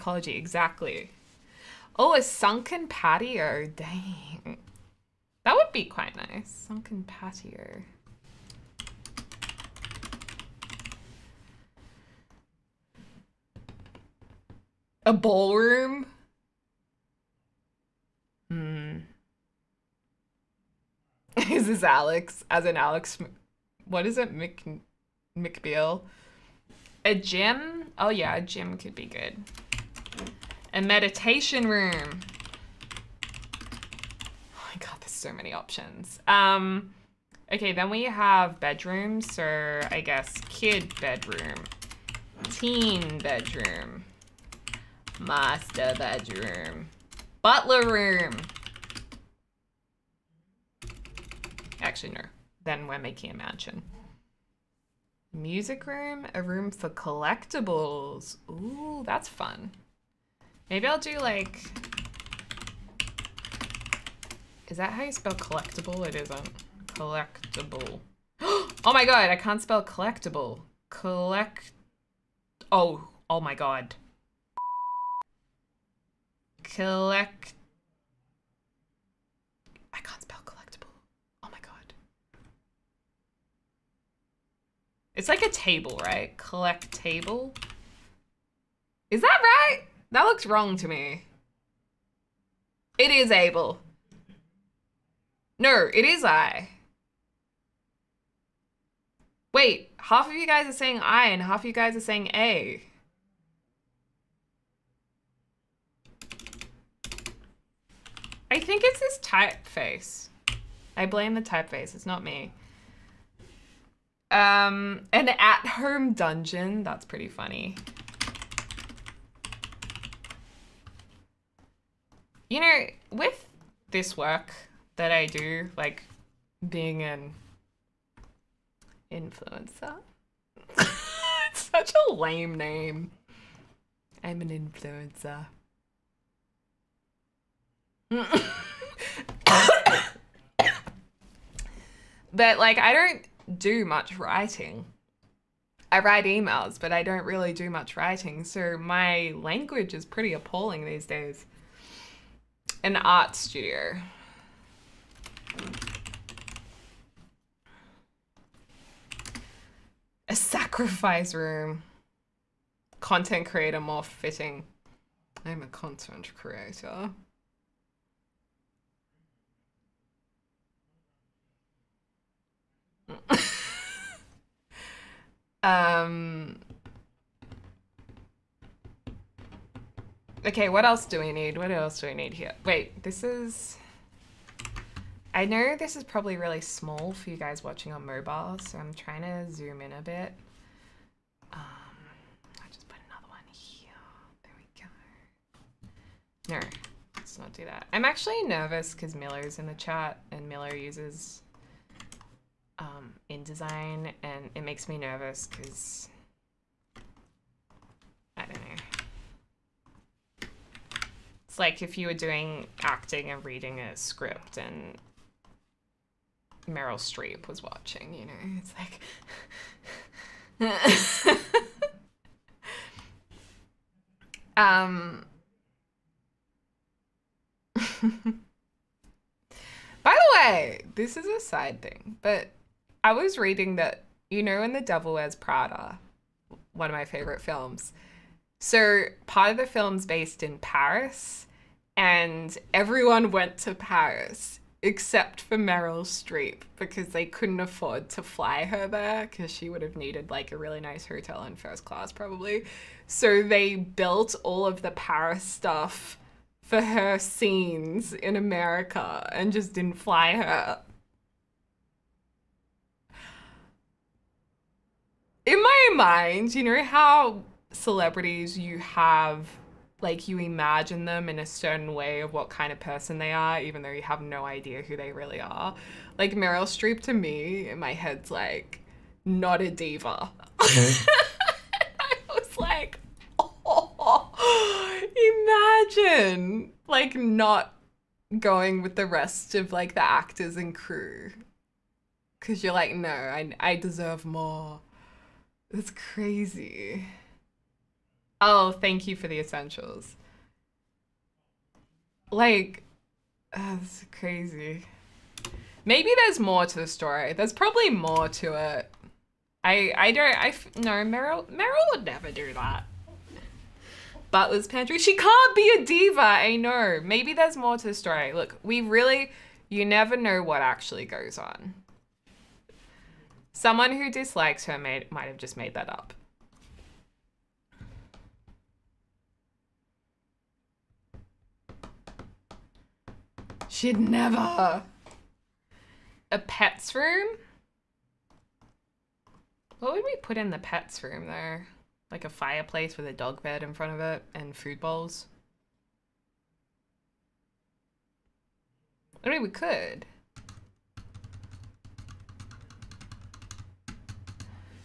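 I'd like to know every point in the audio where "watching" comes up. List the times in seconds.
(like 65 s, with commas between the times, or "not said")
187 s, 217 s.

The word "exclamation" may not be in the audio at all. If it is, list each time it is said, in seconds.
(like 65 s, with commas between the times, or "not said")
not said.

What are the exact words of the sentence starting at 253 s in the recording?
So they built all of the Paris stuff for her scenes in America and just didn't fly her.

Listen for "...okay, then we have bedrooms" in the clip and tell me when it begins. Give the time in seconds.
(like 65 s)
37 s.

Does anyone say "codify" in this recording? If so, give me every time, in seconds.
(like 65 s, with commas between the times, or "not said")
not said.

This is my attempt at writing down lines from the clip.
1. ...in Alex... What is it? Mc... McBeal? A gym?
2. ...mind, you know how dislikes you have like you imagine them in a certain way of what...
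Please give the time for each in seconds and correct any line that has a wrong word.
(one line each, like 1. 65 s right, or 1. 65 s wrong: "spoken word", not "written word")
1. 22 s right
2. 265 s wrong: "celebrities", not "dislikes".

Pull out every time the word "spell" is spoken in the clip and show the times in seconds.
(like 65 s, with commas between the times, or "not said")
65 s, 69 s, 80 s.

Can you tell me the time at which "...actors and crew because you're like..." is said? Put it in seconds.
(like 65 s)
290 s.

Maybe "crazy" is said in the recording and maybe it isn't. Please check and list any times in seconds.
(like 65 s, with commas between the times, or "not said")
295 s, 304 s.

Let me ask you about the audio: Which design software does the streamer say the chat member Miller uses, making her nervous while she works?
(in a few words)
InDesign.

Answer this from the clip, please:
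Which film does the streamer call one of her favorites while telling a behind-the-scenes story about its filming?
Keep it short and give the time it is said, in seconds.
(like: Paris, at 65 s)
The Devil Wears Prada, at 234 s.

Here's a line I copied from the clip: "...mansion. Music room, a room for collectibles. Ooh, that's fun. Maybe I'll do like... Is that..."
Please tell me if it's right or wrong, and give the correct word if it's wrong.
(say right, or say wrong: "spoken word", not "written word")
right.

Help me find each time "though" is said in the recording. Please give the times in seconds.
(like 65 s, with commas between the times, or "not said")
273 s, 341 s.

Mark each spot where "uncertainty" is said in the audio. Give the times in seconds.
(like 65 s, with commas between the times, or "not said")
not said.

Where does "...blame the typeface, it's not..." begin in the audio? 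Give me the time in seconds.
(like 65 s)
111 s.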